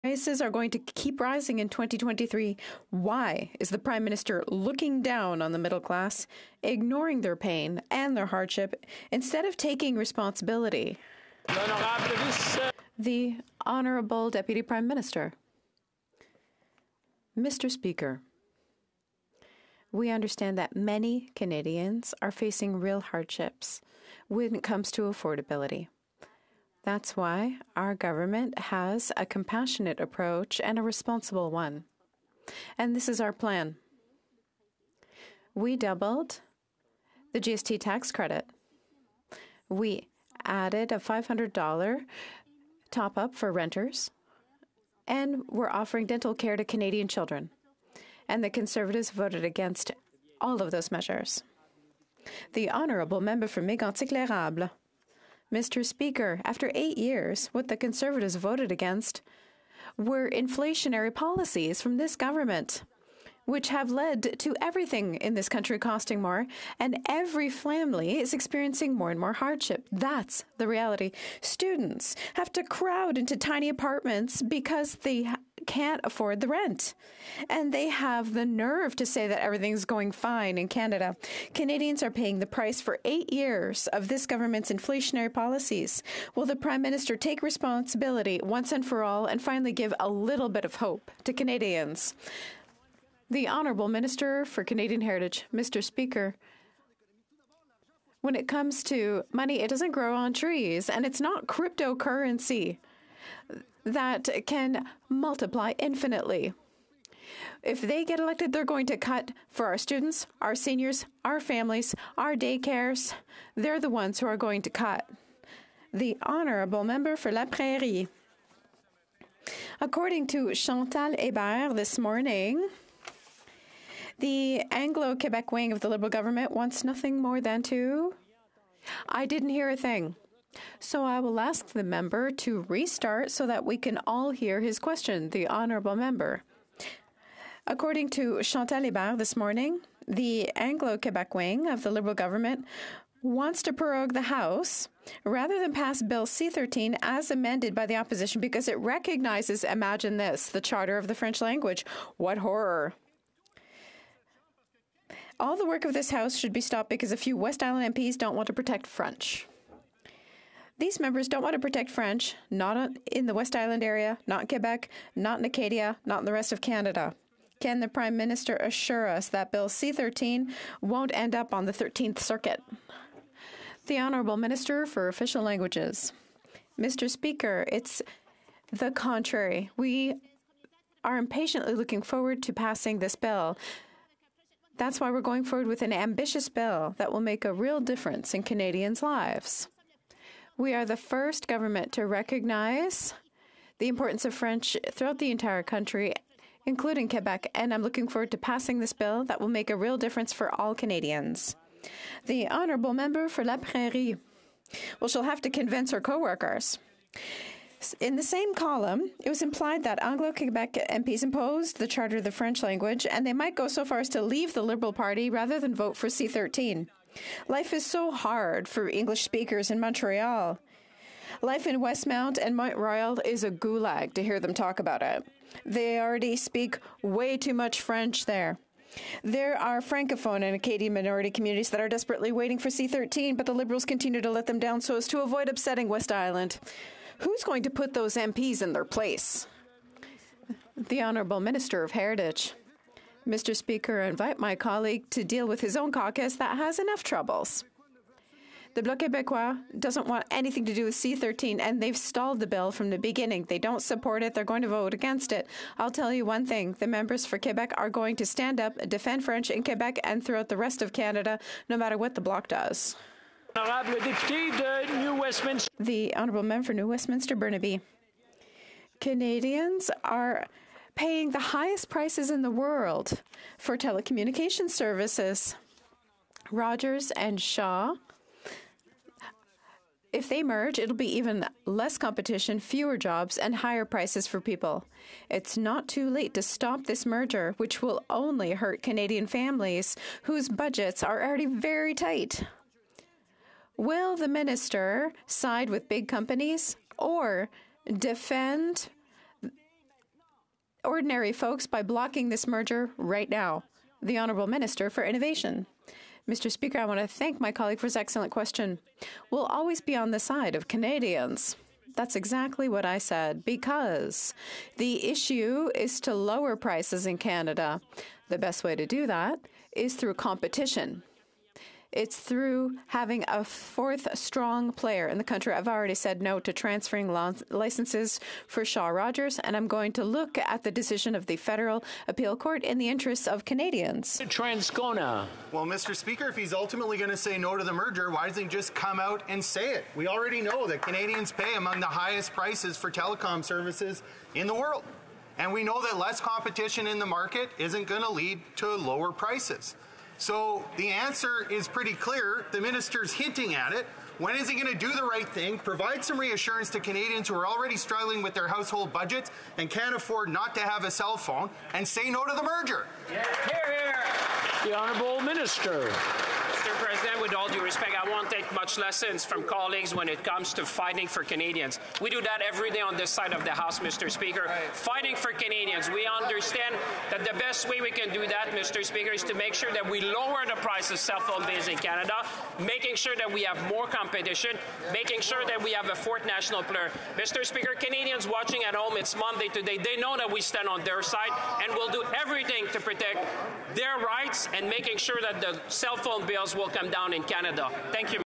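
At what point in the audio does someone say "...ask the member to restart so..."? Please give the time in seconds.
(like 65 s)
131 s.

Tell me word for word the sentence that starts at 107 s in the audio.
If they get elected, they're going to cut for our students, our seniors, our families, our daycares.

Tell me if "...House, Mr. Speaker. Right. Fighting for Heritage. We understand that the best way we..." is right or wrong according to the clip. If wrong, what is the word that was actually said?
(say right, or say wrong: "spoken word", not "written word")
wrong: "Canadians", not "Heritage".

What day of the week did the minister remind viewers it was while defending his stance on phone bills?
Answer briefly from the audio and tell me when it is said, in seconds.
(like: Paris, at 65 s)
Monday, at 389 s.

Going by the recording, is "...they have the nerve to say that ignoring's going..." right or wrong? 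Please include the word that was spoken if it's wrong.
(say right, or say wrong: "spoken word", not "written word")
wrong: "everything", not "ignoring".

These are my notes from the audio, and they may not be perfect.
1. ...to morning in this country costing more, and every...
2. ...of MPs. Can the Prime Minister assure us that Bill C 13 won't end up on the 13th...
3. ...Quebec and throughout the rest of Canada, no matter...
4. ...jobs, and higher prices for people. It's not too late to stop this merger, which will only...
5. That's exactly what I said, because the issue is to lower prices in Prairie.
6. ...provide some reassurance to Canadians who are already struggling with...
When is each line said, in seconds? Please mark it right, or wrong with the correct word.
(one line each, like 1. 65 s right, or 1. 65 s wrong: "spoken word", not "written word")
1. 64 s wrong: "everything", not "morning"
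2. 166 s wrong: "Canada", not "MPs"
3. 259 s right
4. 282 s right
5. 311 s wrong: "Canada", not "Prairie"
6. 355 s right.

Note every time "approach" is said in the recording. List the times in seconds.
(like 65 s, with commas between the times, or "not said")
29 s.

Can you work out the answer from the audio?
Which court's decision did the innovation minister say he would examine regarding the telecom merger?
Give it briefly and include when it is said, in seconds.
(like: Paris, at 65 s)
Federal Appeal Court, at 331 s.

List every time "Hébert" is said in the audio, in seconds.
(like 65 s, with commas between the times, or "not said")
121 s, 138 s.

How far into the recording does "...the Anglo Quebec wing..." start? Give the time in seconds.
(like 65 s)
124 s.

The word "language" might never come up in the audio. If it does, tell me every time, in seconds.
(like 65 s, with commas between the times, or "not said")
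151 s, 175 s, 212 s.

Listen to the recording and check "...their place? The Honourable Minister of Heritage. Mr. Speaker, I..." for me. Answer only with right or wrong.
right.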